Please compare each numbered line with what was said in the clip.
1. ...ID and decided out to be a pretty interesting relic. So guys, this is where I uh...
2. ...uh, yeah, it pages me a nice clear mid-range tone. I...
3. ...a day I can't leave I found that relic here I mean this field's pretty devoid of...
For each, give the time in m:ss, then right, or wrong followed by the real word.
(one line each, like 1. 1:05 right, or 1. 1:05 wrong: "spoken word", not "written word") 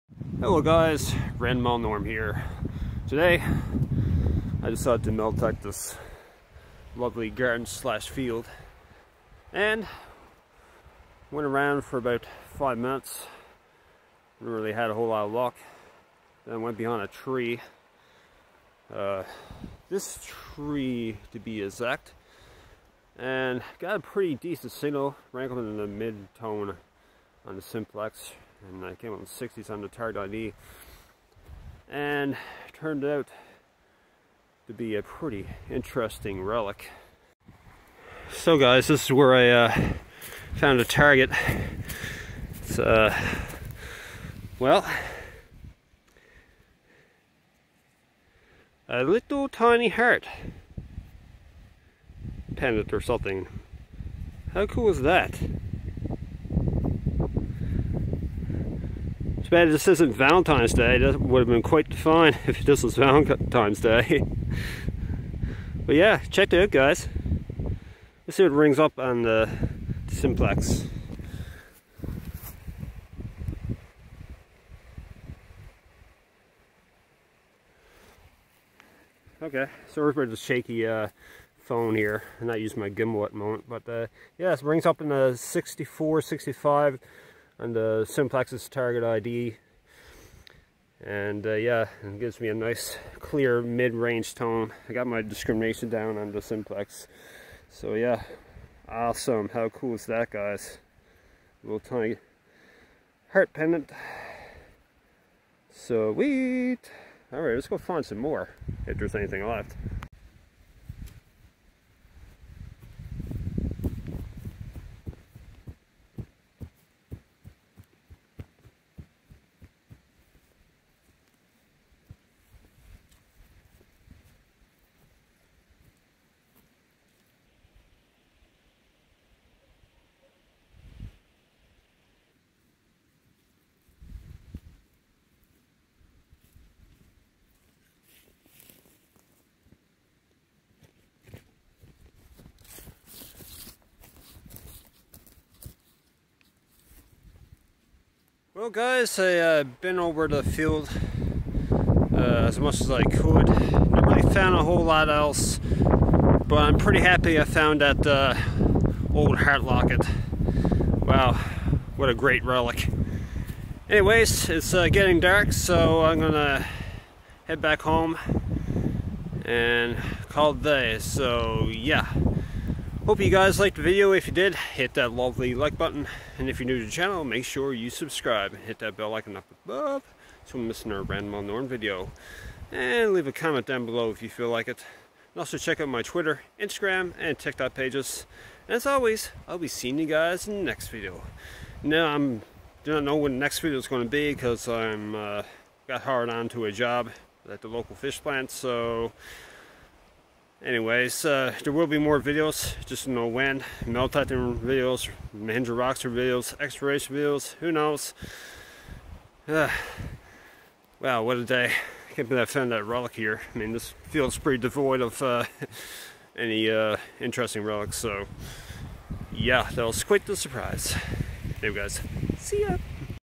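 1. 0:30 wrong: "turned", not "decided"
2. 1:31 wrong: "gives", not "pages"
3. 3:31 wrong: "believe", not "leave".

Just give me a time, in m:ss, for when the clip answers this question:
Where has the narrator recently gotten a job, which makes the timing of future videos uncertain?
3:17.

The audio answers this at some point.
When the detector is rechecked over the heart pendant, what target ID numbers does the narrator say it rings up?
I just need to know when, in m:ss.
1:25.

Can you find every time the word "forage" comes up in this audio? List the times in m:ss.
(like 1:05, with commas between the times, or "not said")
not said.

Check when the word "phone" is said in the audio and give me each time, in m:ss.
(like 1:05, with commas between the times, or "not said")
1:21.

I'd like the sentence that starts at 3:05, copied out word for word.
And also check out my Twitter, Instagram, and TikTok pages.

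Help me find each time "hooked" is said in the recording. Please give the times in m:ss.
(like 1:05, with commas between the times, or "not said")
not said.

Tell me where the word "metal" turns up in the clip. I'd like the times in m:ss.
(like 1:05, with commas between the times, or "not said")
0:05, 3:23.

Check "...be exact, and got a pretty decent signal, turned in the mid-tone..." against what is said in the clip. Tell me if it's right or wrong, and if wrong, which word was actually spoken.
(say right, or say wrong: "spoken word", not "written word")
wrong: "rankled", not "turned".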